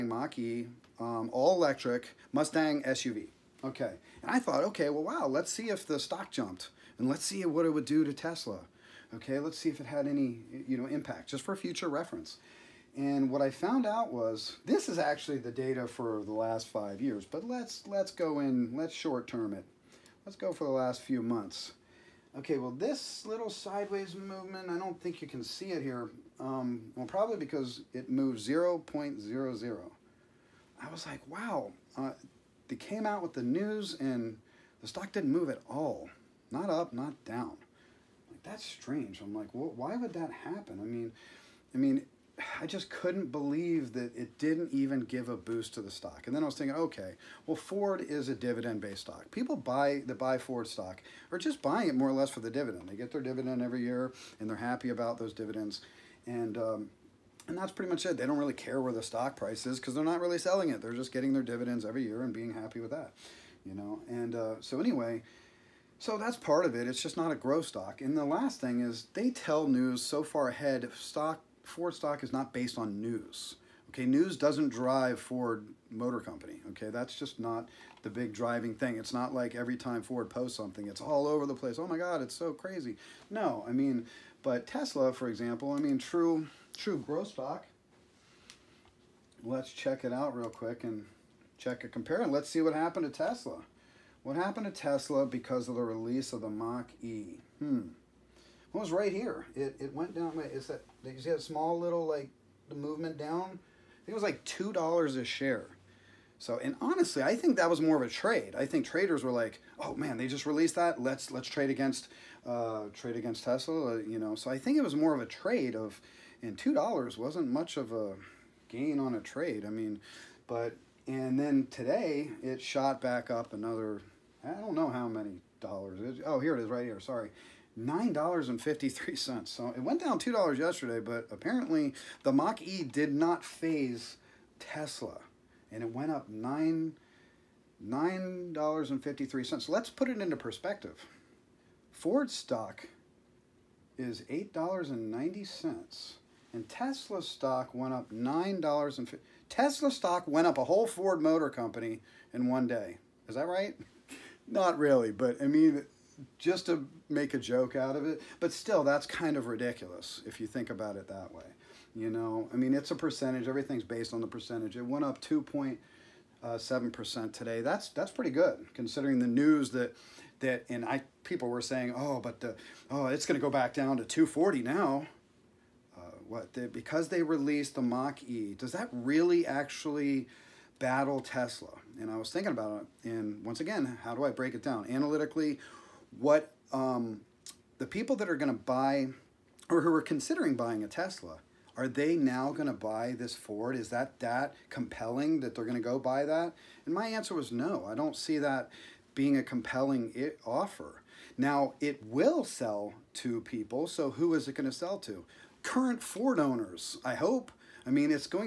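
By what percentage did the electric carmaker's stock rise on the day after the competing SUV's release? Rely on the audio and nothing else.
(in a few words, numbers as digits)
2.7%.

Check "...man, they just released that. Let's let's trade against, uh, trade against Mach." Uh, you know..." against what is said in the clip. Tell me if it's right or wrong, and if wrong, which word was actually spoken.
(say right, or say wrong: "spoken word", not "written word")
wrong: "Tesla", not "Mach".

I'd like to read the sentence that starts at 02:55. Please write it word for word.
Uh, what the, because they released the Mach E?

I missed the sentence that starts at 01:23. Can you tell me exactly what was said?
No, I mean, but Tesla, for example, I mean, true, true growth stock.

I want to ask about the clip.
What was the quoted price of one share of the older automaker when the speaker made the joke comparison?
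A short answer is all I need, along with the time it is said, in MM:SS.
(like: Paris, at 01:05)
$8.90, at 02:24.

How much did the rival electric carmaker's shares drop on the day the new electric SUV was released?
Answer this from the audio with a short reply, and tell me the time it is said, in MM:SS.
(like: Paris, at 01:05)
$2 a share, at 01:44.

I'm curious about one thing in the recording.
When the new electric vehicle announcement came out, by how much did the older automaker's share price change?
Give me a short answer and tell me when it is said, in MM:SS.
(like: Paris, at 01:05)
0.00, at 00:28.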